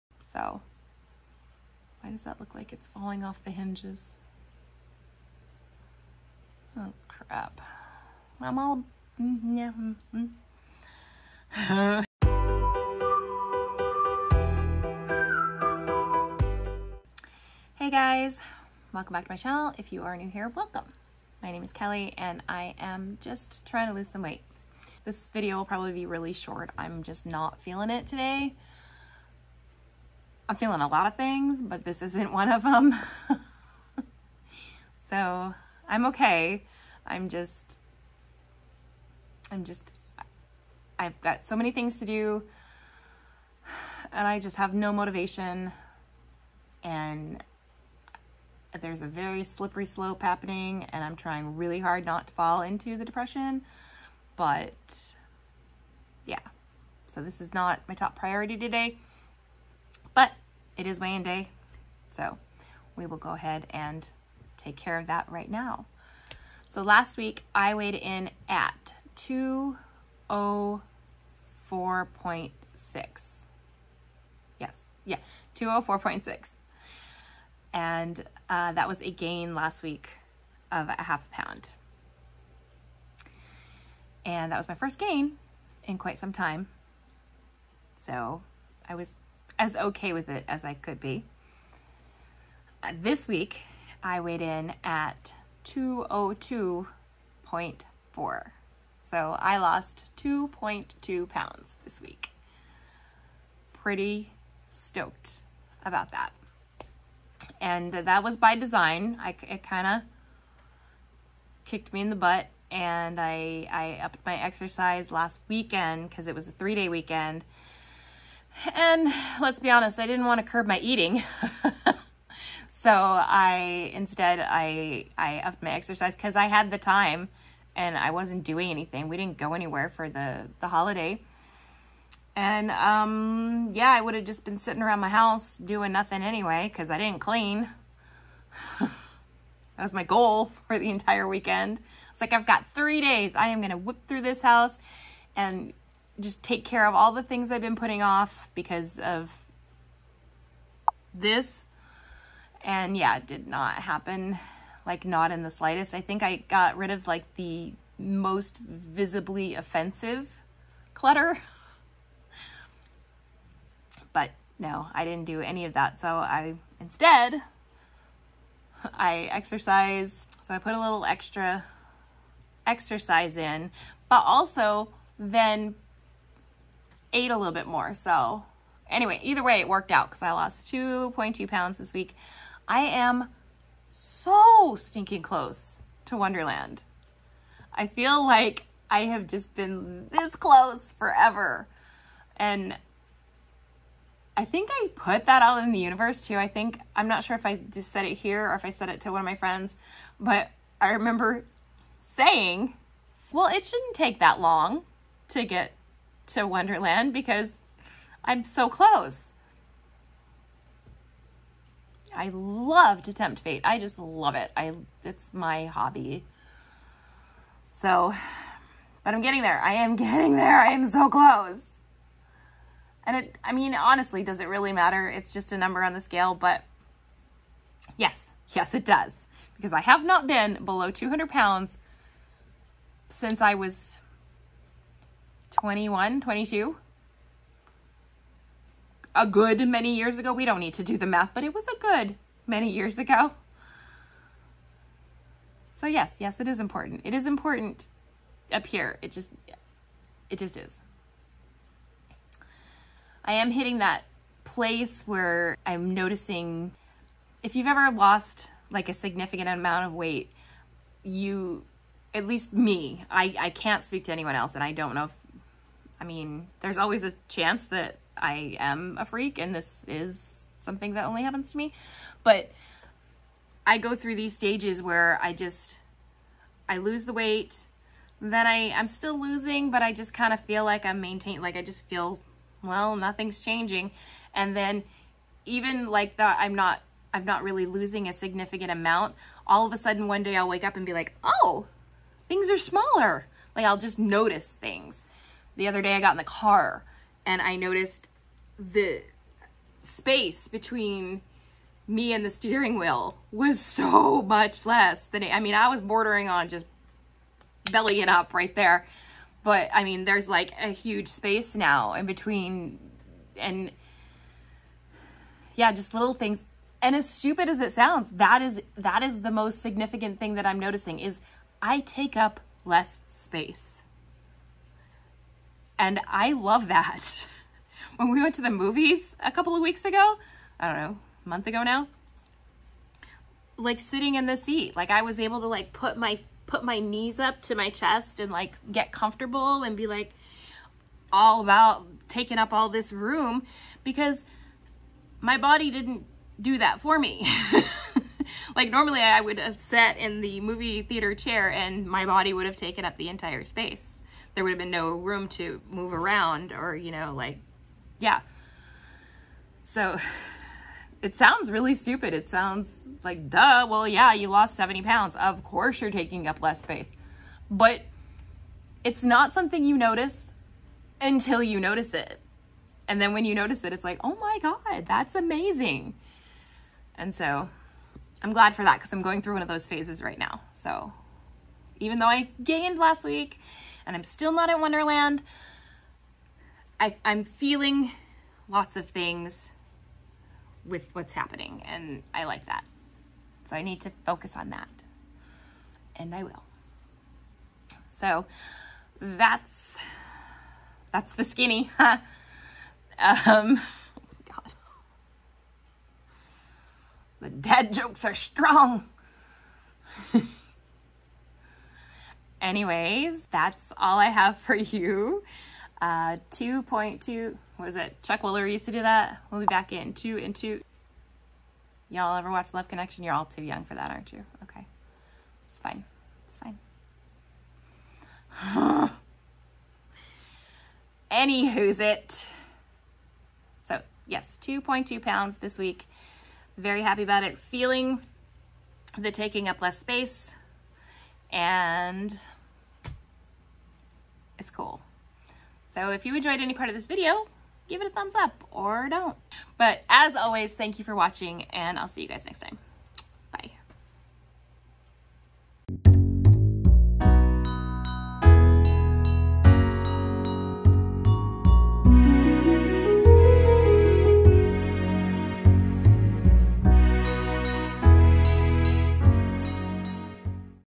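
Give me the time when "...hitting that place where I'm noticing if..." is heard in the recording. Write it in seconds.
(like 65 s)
253 s.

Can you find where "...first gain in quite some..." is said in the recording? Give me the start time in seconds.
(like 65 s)
84 s.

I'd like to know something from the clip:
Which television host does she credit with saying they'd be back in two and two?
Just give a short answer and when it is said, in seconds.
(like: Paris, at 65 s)
Chuck Woolery, at 418 s.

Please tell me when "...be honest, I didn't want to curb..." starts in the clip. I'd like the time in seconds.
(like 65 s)
119 s.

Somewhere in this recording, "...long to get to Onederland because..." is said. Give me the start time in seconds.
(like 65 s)
204 s.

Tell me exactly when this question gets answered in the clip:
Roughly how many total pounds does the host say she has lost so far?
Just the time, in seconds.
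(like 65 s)
364 s.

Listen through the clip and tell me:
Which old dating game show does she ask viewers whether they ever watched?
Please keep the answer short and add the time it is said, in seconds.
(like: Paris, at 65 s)
Love Connection, at 422 s.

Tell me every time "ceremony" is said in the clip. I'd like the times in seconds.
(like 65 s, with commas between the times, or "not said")
not said.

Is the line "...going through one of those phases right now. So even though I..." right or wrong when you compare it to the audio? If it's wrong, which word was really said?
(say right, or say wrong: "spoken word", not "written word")
right.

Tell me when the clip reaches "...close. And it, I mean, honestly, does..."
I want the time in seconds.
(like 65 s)
221 s.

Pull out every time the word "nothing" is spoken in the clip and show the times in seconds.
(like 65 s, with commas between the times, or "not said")
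135 s, 282 s.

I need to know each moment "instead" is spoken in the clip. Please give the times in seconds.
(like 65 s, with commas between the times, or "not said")
123 s, 166 s.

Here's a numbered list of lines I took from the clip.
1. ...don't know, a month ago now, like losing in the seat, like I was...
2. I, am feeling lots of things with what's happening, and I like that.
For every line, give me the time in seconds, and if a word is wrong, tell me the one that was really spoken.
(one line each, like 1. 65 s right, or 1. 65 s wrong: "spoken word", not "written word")
1. 330 s wrong: "sitting", not "losing"
2. 386 s right.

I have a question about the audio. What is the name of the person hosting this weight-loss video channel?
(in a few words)
Kelly.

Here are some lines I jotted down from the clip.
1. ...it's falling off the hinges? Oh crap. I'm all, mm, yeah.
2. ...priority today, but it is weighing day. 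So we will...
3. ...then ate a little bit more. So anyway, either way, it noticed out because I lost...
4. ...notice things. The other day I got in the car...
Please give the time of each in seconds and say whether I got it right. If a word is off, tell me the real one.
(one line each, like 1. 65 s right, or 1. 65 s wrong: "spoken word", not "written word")
1. 2 s right
2. 58 s right
3. 175 s wrong: "worked", not "noticed"
4. 293 s right.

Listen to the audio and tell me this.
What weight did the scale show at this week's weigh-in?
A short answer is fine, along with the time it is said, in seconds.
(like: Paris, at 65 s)
202.4, at 95 s.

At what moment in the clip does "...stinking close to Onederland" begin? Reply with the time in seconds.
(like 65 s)
184 s.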